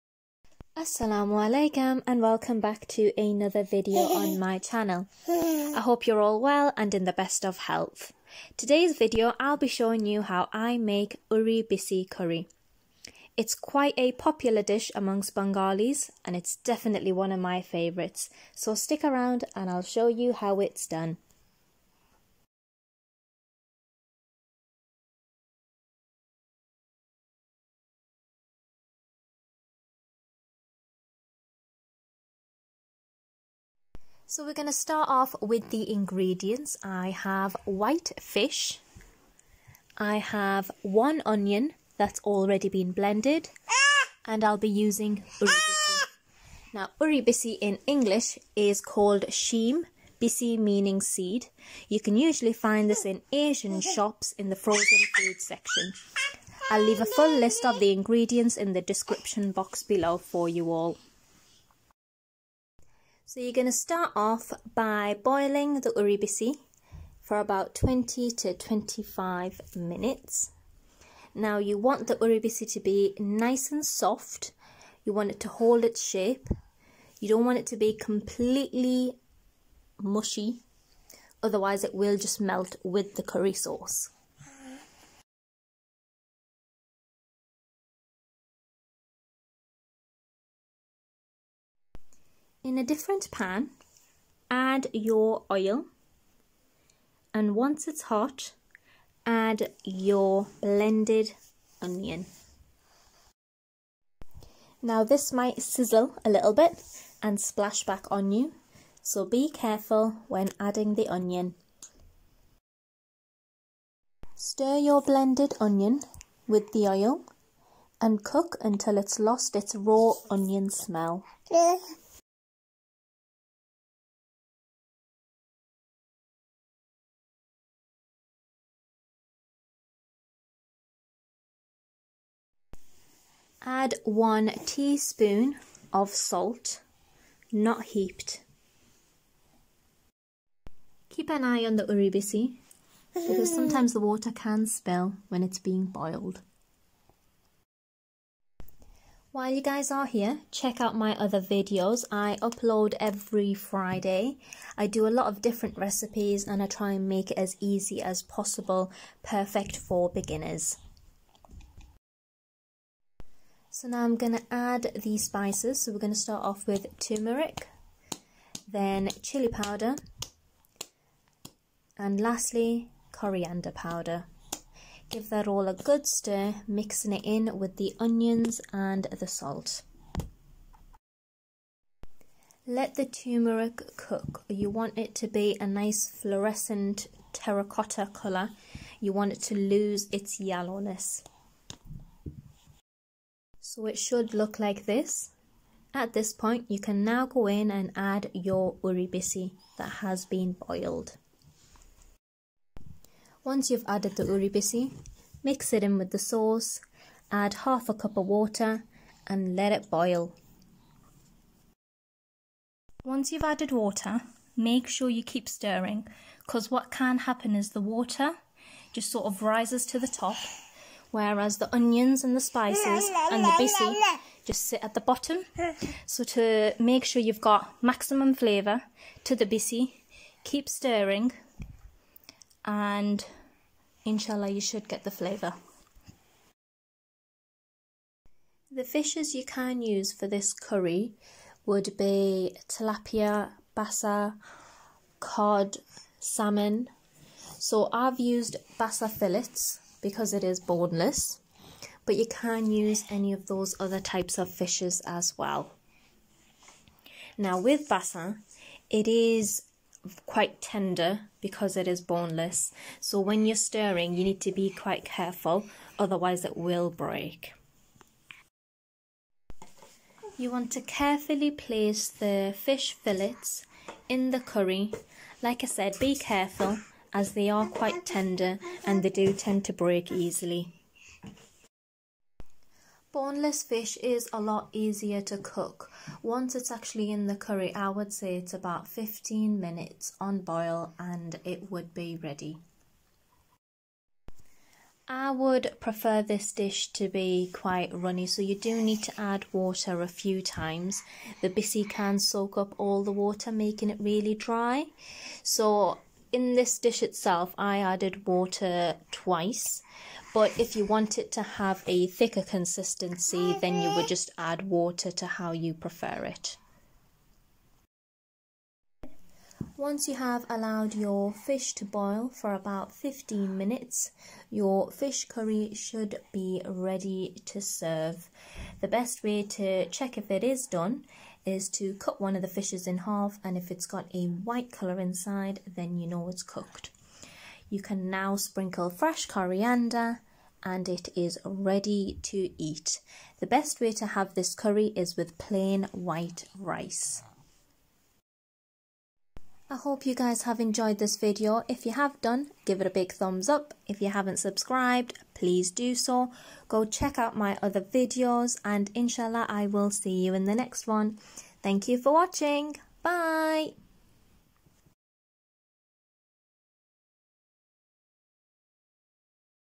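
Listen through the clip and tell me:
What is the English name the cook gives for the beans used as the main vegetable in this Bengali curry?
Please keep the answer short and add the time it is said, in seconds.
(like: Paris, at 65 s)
sheem, at 49 s.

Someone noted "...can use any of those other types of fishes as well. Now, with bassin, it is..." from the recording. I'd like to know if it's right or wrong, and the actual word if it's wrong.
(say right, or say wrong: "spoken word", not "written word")
right.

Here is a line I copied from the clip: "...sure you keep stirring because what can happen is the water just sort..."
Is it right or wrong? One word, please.
right.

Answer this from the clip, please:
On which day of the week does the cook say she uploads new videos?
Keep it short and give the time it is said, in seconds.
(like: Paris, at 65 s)
Friday, at 153 s.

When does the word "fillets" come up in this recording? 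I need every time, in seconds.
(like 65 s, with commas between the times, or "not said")
249 s, 272 s.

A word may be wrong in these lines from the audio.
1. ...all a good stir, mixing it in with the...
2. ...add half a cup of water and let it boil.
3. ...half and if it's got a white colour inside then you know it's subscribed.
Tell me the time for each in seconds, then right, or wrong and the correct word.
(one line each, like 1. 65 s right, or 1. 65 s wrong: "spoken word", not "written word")
1. 175 s right
2. 207 s right
3. 332 s wrong: "cooked", not "subscribed".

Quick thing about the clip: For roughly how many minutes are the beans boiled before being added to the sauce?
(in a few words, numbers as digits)
20 to 25 minutes.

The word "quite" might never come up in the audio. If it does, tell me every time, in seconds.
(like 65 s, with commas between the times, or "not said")
13 s, 260 s, 264 s, 277 s, 297 s.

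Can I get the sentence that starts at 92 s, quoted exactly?
In a different pan, add your oil and once it's hot, add your blended onion.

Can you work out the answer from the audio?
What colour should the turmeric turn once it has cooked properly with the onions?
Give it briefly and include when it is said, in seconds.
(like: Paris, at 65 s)
fluorescent terracotta, at 186 s.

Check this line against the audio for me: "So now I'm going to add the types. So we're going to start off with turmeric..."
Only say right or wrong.
wrong.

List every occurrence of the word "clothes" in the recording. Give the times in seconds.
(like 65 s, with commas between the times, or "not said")
not said.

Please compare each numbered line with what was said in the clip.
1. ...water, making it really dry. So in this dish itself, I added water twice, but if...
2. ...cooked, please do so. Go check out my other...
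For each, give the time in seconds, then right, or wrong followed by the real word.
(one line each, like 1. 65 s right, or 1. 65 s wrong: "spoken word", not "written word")
1. 303 s right
2. 354 s wrong: "subscribed", not "cooked".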